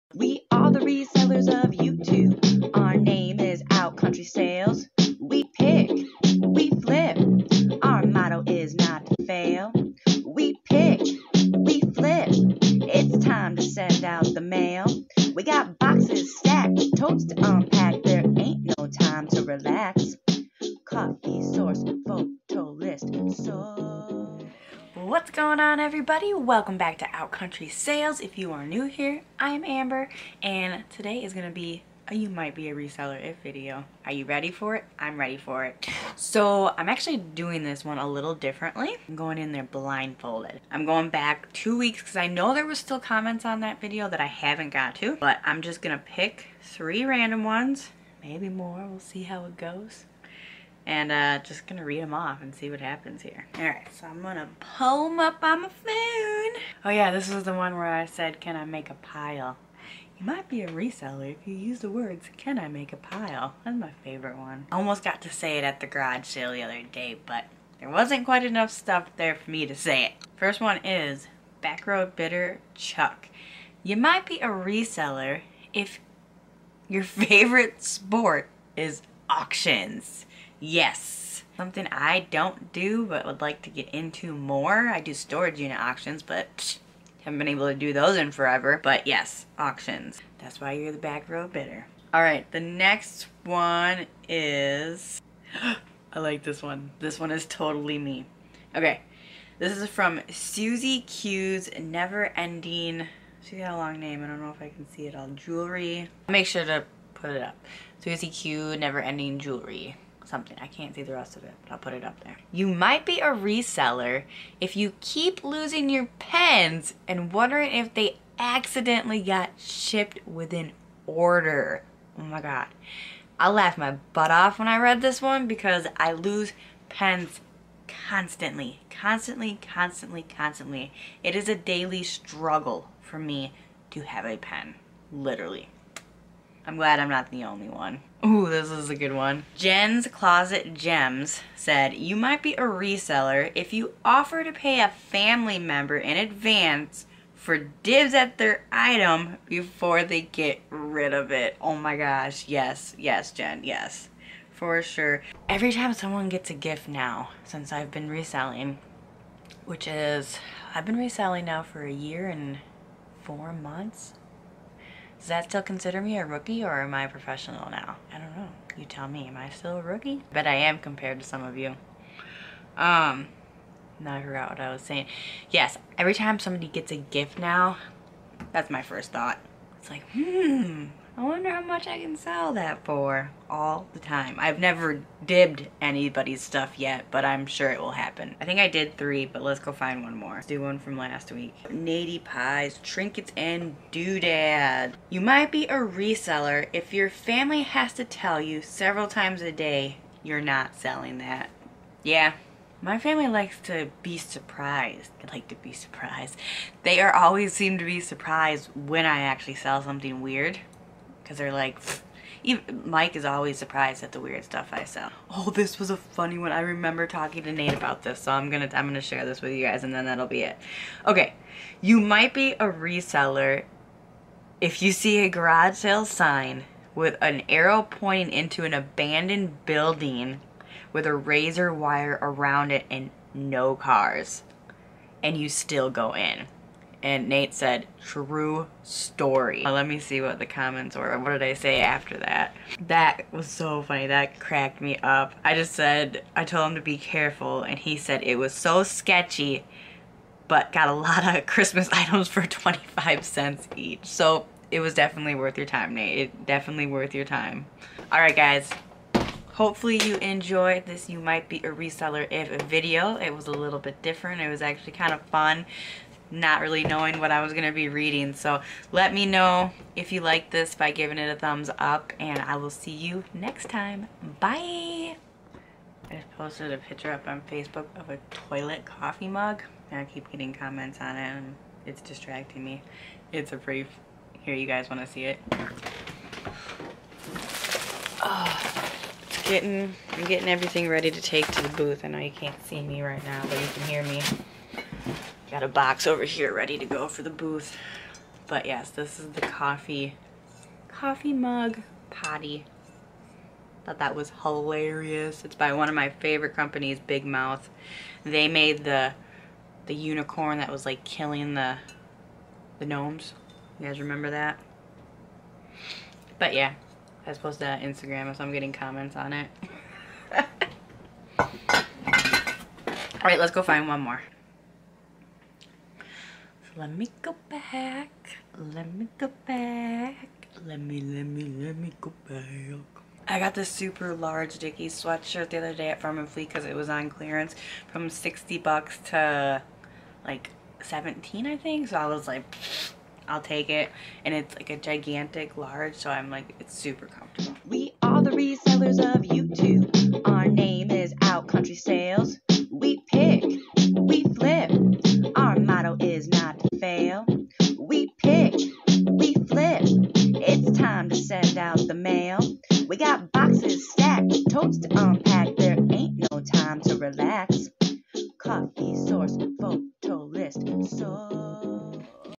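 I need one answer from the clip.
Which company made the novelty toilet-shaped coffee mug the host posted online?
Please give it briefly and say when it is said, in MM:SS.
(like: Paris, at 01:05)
Big Mouth, at 05:07.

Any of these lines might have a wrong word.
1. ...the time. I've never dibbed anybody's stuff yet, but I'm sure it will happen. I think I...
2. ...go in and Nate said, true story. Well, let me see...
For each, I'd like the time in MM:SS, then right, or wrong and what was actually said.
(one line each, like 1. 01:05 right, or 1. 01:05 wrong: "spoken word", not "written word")
1. 03:03 right
2. 03:55 right.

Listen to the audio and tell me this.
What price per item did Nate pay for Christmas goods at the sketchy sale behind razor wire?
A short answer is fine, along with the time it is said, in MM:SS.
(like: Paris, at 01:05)
25 cents, at 04:12.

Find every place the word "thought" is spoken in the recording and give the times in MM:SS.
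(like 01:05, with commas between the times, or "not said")
02:59, 05:03.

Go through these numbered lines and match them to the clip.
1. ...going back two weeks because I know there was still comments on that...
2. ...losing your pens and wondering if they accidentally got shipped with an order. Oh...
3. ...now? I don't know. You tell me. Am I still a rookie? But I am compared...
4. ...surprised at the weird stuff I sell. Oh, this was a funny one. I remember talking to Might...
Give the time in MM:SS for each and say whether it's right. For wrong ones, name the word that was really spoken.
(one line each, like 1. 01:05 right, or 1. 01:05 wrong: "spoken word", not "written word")
1. 00:40 right
2. 01:55 right
3. 02:47 right
4. 03:33 wrong: "Nate", not "Might".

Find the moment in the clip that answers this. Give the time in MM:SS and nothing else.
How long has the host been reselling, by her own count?
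02:41.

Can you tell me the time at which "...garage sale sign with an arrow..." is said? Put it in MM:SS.
03:45.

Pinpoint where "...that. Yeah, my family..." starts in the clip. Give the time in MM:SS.
03:21.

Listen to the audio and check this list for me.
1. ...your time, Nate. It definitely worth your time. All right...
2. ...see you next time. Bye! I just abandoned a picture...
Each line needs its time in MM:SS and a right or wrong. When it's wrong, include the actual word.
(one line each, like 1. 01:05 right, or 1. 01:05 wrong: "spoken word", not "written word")
1. 04:15 right
2. 04:32 wrong: "posted", not "abandoned".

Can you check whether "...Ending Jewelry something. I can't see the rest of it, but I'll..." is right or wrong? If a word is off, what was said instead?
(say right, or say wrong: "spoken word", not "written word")
right.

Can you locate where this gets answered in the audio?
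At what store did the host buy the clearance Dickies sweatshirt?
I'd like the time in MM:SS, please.
05:36.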